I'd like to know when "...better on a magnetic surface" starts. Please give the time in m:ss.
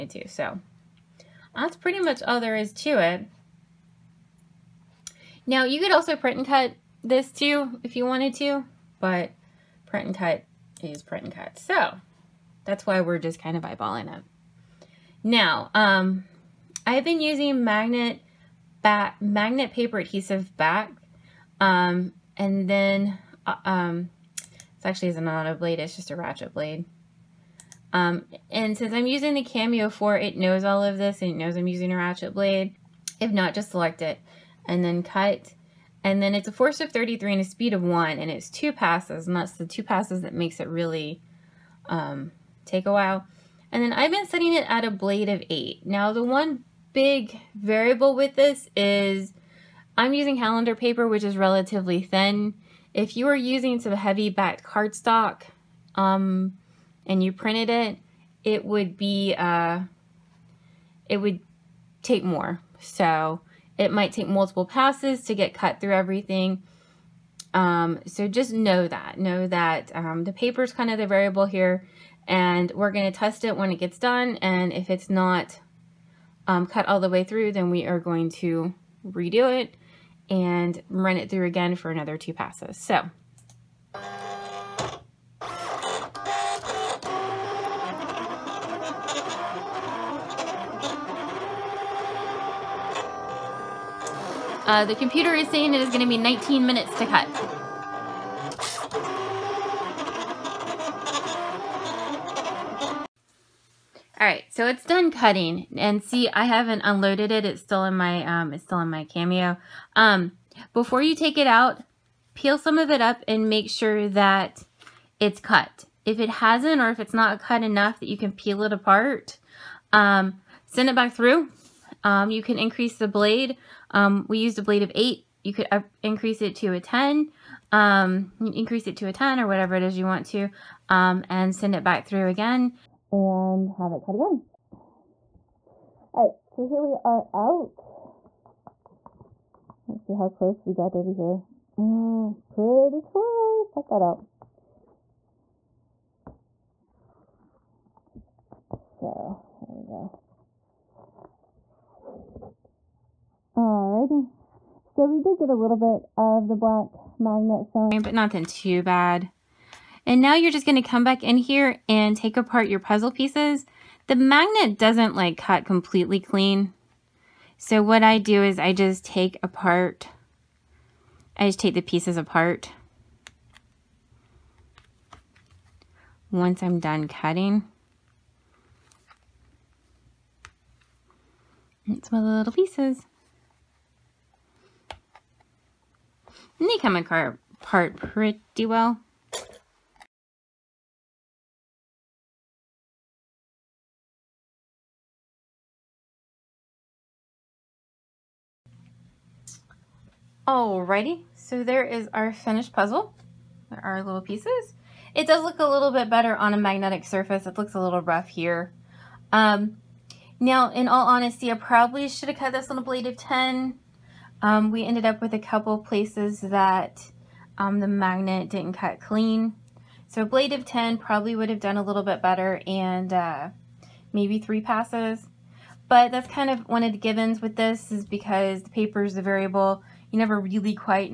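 3:26.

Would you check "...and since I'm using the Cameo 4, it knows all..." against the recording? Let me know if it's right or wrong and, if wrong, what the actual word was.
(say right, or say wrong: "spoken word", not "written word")
right.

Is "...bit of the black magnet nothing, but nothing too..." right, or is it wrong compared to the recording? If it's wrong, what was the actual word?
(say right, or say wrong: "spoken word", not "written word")
wrong: "showing", not "nothing".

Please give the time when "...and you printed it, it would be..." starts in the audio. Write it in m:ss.
0:57.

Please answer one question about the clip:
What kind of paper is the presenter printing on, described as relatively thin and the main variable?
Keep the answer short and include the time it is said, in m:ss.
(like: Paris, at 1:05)
calendar paper, at 0:50.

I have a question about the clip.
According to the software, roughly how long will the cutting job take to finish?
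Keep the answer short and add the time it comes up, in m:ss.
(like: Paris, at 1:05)
19 minutes, at 1:36.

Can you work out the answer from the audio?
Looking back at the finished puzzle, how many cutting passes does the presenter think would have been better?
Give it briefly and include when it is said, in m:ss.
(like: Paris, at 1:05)
3, at 3:44.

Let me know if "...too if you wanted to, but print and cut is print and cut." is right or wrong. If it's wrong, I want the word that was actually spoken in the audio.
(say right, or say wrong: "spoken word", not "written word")
right.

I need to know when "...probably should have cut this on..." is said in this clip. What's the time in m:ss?
3:31.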